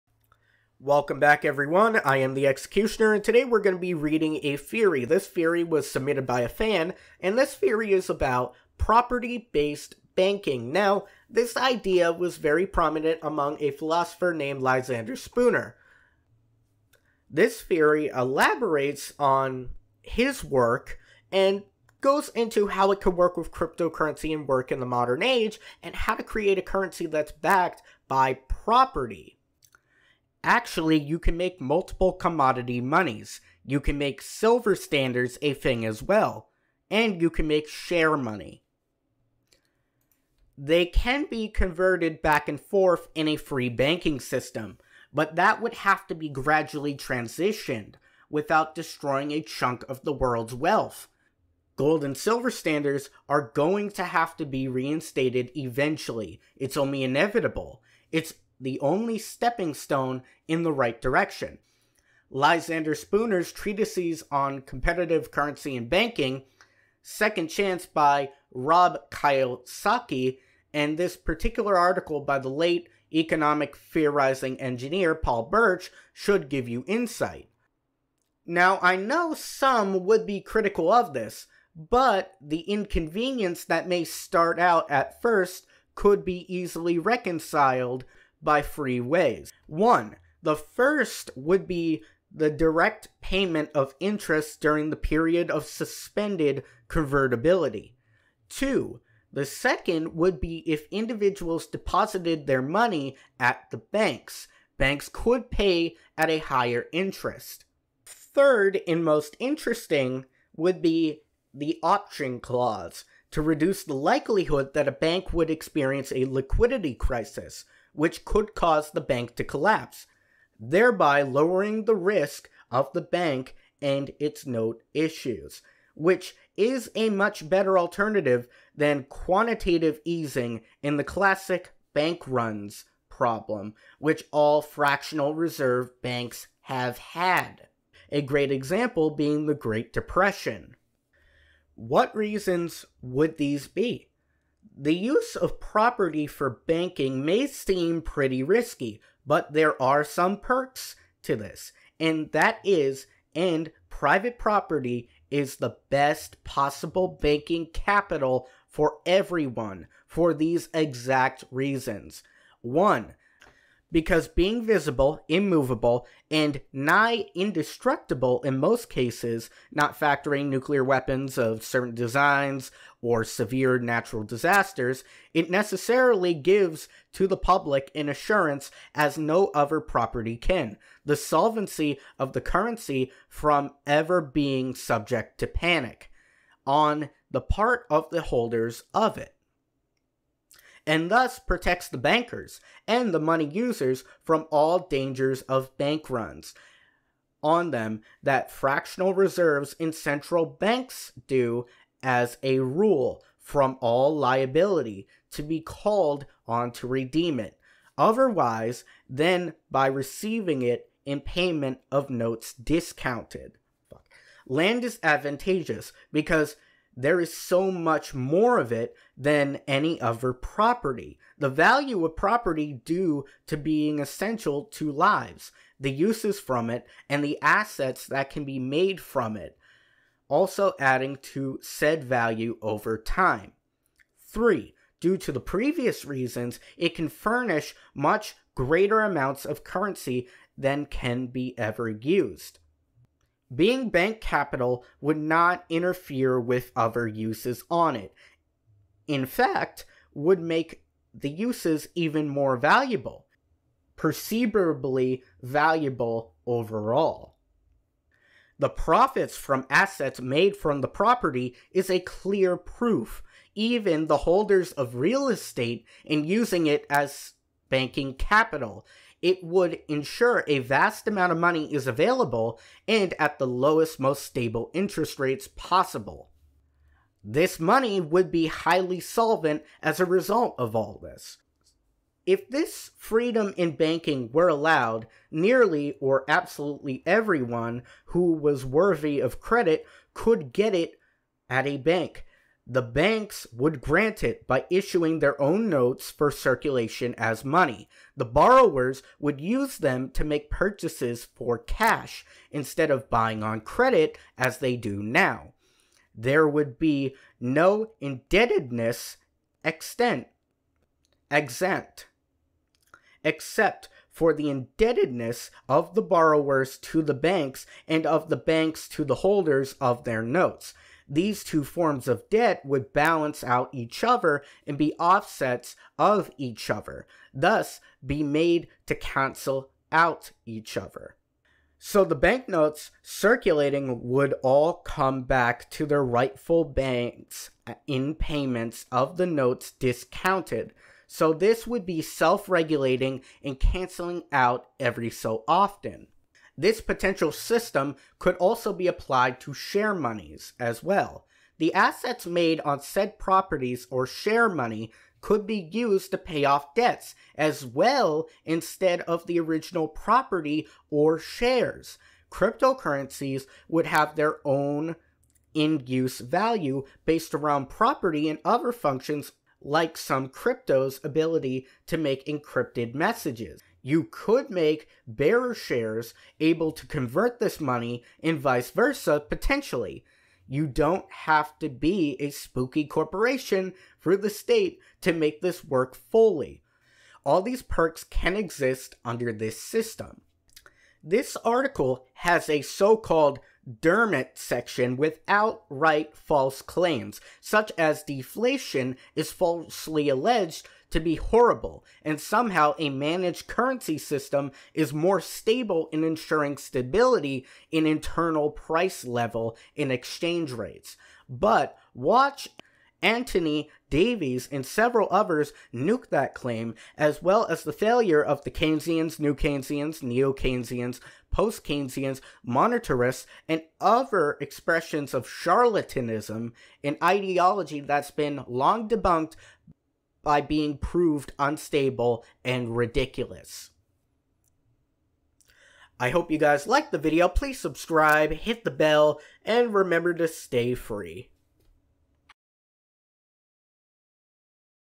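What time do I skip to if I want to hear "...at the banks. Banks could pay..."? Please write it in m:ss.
1:43.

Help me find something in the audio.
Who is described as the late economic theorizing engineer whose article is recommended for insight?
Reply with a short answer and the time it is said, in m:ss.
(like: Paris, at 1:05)
Paul Birch, at 1:15.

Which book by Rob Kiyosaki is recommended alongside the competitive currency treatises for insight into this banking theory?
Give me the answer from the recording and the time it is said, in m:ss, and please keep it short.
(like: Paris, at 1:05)
Second Chance, at 1:07.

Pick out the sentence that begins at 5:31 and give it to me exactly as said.
So the banknotes circulating would all come back to their rightful banks in payments of the notes discounted.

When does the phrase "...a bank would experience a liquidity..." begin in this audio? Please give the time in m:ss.
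1:54.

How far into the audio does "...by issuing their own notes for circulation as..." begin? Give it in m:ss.
4:54.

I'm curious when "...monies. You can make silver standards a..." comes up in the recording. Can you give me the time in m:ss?
0:32.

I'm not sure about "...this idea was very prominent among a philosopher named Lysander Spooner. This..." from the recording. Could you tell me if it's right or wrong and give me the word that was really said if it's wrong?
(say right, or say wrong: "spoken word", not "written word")
right.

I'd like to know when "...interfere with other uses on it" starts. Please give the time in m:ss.
4:05.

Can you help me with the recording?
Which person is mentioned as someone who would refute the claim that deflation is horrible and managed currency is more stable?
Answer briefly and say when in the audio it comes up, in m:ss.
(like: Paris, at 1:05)
Anthony Davies, at 6:53.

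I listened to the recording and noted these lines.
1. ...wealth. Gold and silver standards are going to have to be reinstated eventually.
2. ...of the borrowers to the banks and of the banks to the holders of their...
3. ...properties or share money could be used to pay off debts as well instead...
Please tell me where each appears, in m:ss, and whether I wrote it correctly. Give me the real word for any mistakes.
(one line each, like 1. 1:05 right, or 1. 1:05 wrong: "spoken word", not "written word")
1. 0:50 right
2. 5:15 right
3. 5:53 right.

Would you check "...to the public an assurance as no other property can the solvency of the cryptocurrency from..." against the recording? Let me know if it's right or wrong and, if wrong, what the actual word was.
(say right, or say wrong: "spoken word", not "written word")
wrong: "currency", not "cryptocurrency".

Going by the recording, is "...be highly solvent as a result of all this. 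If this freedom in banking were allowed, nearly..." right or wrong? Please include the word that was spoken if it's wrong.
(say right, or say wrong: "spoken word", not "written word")
right.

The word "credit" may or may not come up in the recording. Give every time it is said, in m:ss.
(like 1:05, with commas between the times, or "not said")
4:49, 5:03.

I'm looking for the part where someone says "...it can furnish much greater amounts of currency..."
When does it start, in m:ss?
3:56.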